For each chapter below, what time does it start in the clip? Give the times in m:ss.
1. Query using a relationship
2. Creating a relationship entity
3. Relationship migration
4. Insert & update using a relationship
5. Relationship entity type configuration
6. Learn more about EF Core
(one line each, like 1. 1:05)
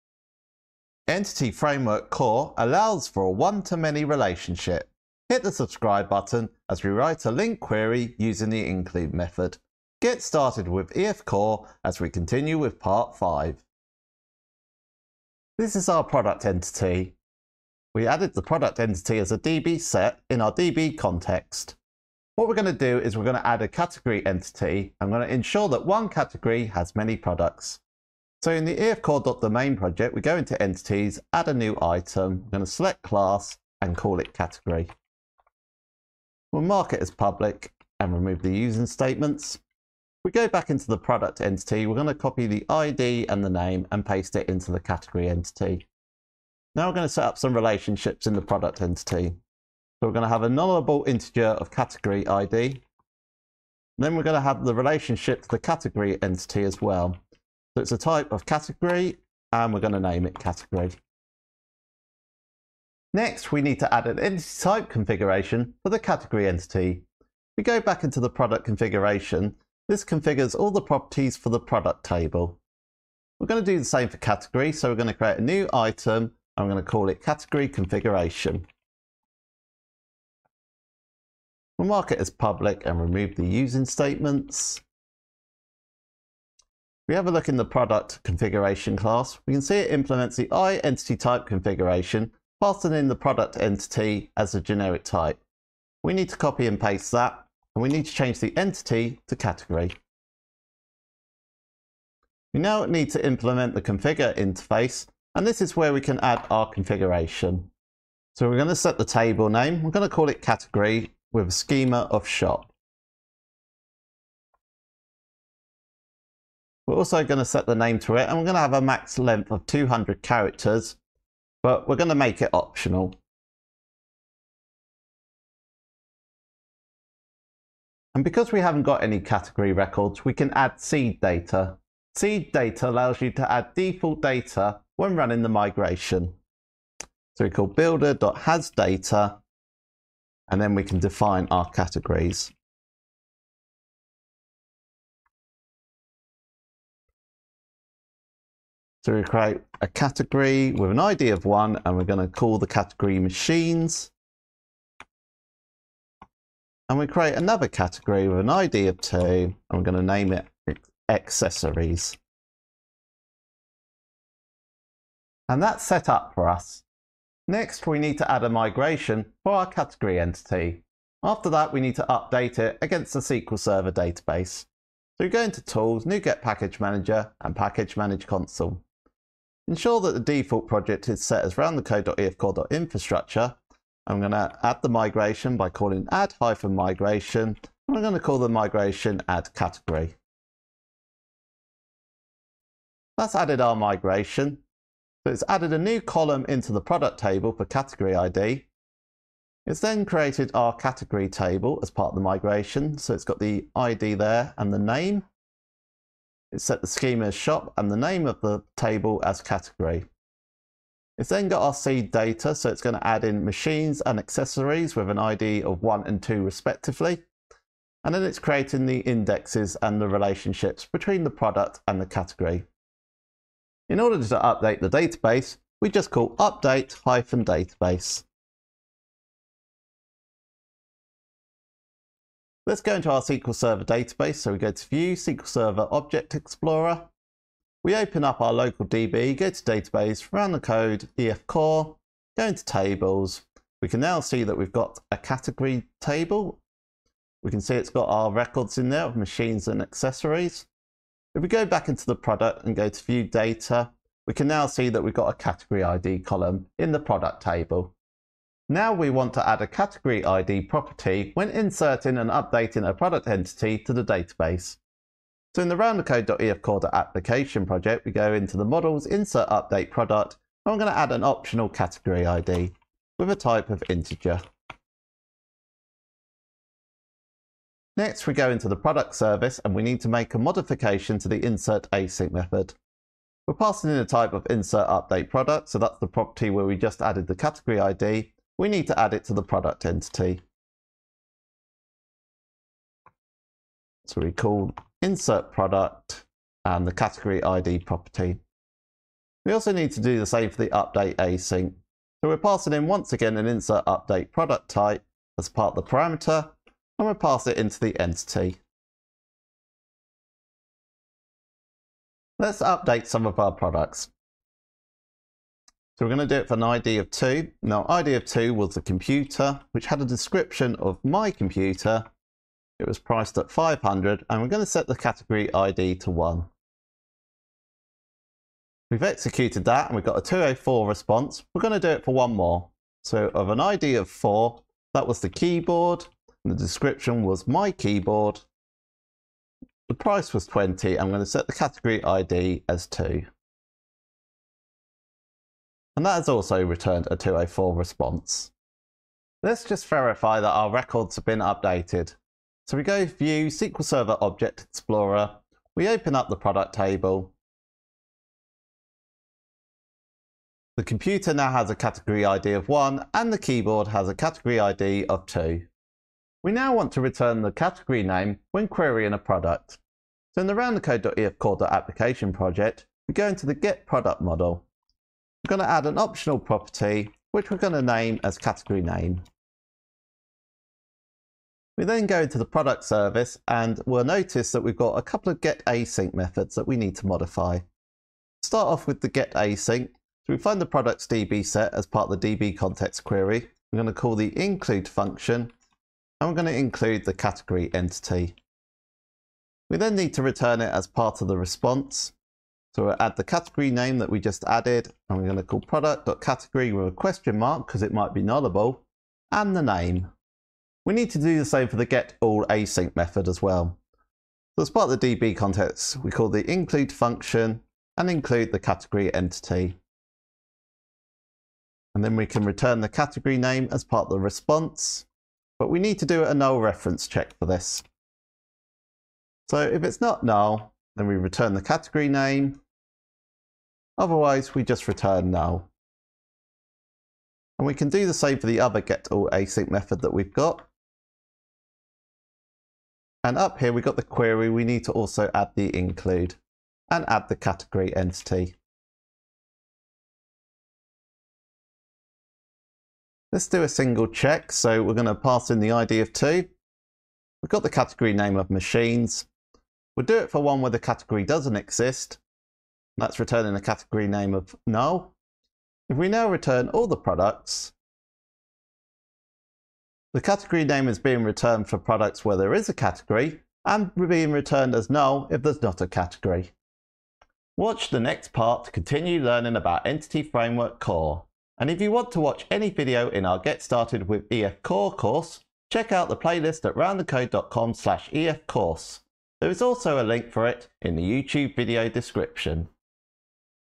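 1. 6:05
2. 0:14
3. 2:47
4. 4:18
5. 1:02
6. 7:56.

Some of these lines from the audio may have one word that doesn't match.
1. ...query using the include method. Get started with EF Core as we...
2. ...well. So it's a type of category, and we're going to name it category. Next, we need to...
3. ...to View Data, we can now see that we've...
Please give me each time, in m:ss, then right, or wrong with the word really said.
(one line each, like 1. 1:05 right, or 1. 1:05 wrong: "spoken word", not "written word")
1. 0:07 right
2. 0:56 right
3. 4:12 right.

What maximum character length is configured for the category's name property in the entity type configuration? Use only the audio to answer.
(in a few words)
200.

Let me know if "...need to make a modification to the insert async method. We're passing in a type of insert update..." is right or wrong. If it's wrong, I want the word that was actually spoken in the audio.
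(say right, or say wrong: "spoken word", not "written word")
right.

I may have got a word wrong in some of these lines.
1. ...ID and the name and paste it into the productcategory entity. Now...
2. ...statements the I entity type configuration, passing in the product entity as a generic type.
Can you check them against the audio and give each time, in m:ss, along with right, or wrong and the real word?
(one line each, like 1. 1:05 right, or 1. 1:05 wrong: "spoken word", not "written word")
1. 0:42 wrong: "category", not "productcategory"
2. 1:29 wrong: "implements", not "statements".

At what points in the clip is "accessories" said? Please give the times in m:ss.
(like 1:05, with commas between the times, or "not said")
2:41, 3:34, 4:09.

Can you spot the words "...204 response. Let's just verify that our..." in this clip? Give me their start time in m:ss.
5:47.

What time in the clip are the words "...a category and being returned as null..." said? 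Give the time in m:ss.
7:52.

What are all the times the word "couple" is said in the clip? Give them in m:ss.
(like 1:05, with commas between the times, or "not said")
6:25.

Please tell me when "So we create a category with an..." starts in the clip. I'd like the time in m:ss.
2:29.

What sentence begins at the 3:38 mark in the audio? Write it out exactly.
And then it's creating the indexes and the relationships between the product and the category.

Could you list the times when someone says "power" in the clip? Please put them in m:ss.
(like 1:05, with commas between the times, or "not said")
not said.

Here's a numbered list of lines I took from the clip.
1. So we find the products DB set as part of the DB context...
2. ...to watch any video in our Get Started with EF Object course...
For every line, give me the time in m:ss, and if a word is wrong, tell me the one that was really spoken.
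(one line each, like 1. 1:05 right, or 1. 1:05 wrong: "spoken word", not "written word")
1. 6:29 right
2. 8:02 wrong: "Core", not "Object".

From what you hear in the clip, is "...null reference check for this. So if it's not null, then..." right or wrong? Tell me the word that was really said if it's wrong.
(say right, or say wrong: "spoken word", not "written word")
right.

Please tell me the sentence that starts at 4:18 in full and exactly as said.
Now we want to add a category ID property when inserting and updating a product entity to the database.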